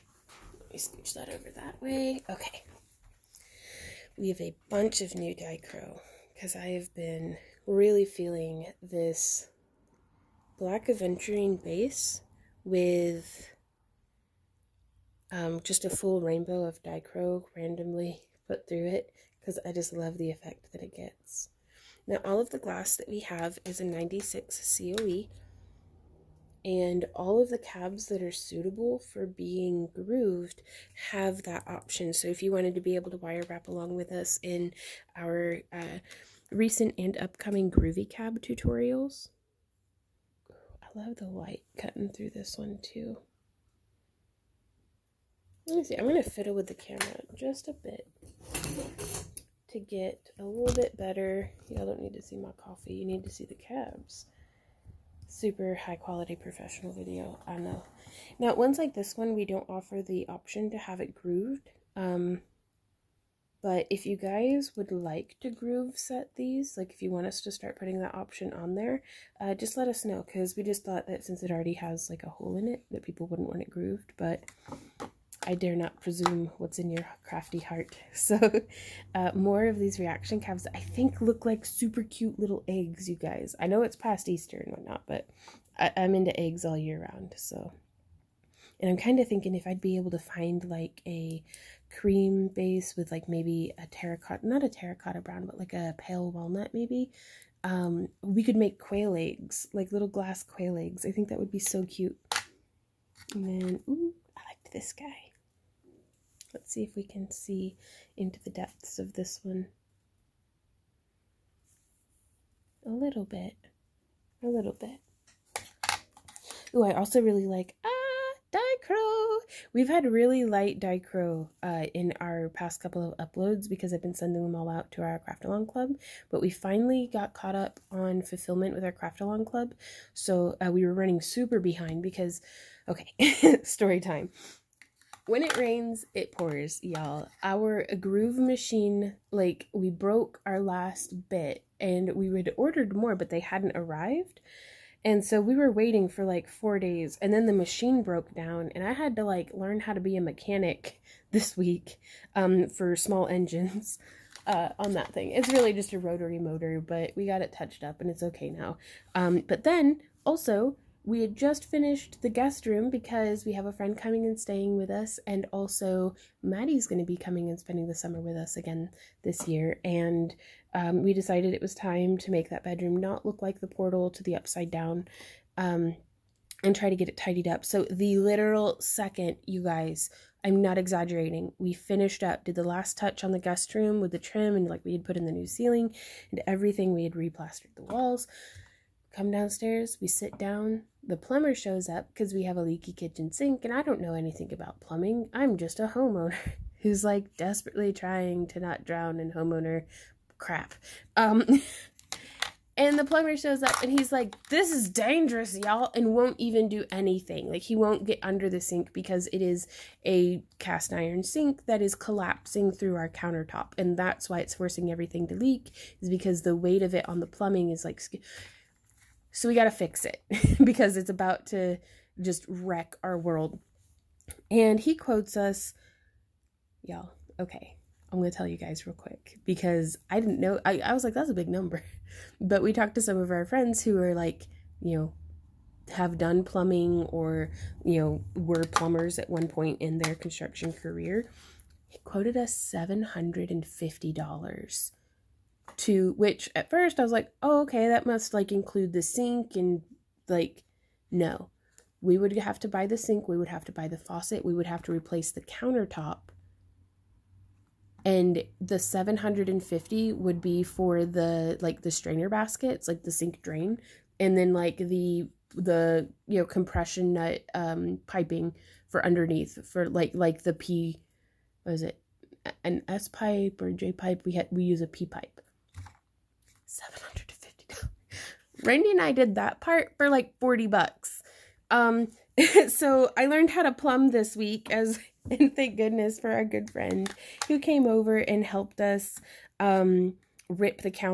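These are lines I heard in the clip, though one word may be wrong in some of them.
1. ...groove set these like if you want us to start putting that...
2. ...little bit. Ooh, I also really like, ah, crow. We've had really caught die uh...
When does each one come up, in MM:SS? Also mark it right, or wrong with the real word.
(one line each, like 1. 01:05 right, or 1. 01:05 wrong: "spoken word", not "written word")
1. 01:05 right
2. 01:54 wrong: "light", not "caught".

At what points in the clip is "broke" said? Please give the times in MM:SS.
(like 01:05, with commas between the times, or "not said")
02:19, 02:28.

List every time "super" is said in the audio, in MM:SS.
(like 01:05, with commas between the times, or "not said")
00:55, 01:21, 02:11.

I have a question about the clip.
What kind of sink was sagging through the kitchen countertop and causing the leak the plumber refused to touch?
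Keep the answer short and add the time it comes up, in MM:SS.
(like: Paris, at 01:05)
Cast iron sink, at 03:30.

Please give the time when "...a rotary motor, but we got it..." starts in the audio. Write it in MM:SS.
02:35.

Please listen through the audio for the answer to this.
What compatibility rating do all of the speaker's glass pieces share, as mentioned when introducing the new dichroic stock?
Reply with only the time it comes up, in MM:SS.
00:23.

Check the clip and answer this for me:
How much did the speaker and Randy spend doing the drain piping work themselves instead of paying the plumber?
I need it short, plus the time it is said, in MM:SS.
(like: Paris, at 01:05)
$40, at 04:40.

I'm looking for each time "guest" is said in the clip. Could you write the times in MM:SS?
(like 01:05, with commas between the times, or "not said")
02:42, 03:03.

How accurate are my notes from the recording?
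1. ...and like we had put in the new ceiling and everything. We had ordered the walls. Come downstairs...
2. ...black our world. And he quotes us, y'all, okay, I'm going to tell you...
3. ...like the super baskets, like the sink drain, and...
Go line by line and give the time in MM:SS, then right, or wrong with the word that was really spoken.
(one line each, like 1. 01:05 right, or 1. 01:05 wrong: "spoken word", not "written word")
1. 03:04 wrong: "replastered", not "ordered"
2. 03:42 wrong: "wreck", not "black"
3. 04:21 wrong: "strainer", not "super".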